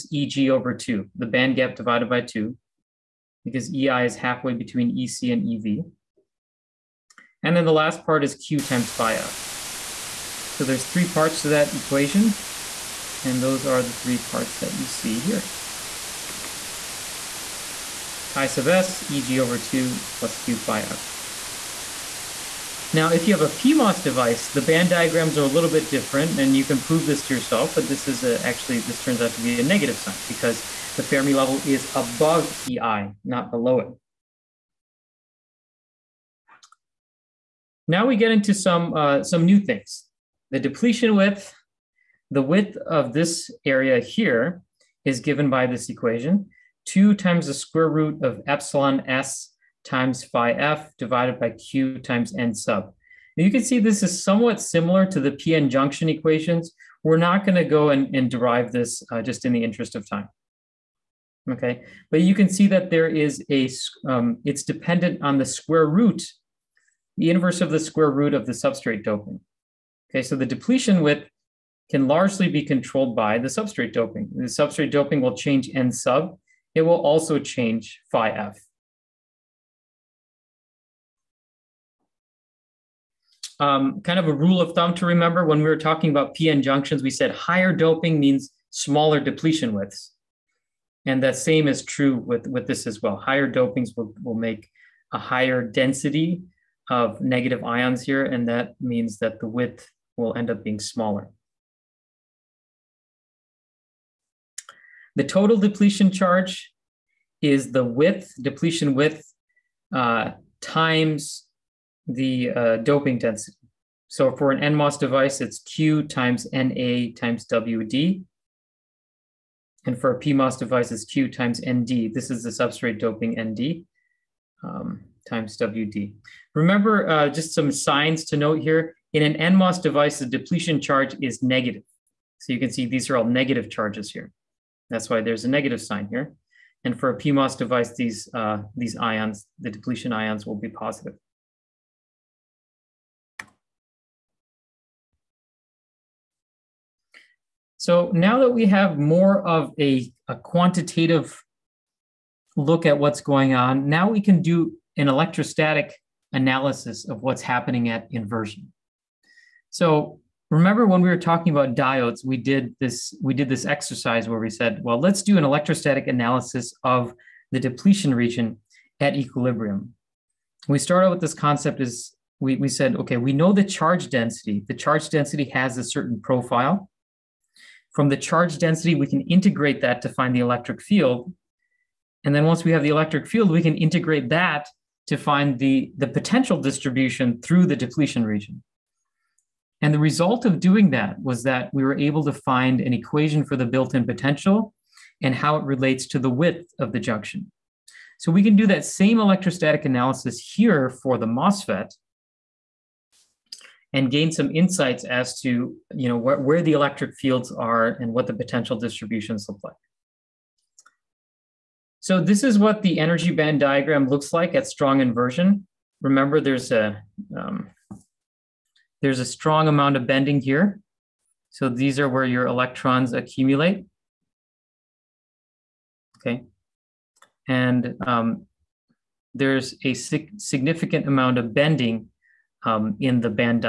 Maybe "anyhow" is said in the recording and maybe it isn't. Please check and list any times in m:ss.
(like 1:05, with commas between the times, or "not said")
not said.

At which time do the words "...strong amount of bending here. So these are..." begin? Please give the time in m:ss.
3:39.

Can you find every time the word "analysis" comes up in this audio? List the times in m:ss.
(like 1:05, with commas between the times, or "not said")
2:36, 2:46, 3:19.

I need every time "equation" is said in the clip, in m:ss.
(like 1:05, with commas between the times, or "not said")
0:11, 0:45, 0:56, 3:12.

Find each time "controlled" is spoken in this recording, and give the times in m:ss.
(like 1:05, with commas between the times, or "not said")
1:12.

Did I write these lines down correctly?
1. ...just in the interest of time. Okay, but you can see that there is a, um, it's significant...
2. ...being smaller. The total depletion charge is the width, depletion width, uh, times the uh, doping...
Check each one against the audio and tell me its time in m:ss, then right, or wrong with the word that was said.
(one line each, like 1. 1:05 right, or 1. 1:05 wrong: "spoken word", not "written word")
1. 0:59 wrong: "dependent", not "significant"
2. 1:40 right.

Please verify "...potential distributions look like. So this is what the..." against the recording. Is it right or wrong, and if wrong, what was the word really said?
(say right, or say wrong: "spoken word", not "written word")
right.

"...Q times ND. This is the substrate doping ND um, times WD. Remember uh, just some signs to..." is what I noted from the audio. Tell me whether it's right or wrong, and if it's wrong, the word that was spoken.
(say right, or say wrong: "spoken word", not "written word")
right.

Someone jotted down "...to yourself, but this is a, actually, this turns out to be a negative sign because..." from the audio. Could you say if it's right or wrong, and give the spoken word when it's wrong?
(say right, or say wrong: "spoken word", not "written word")
right.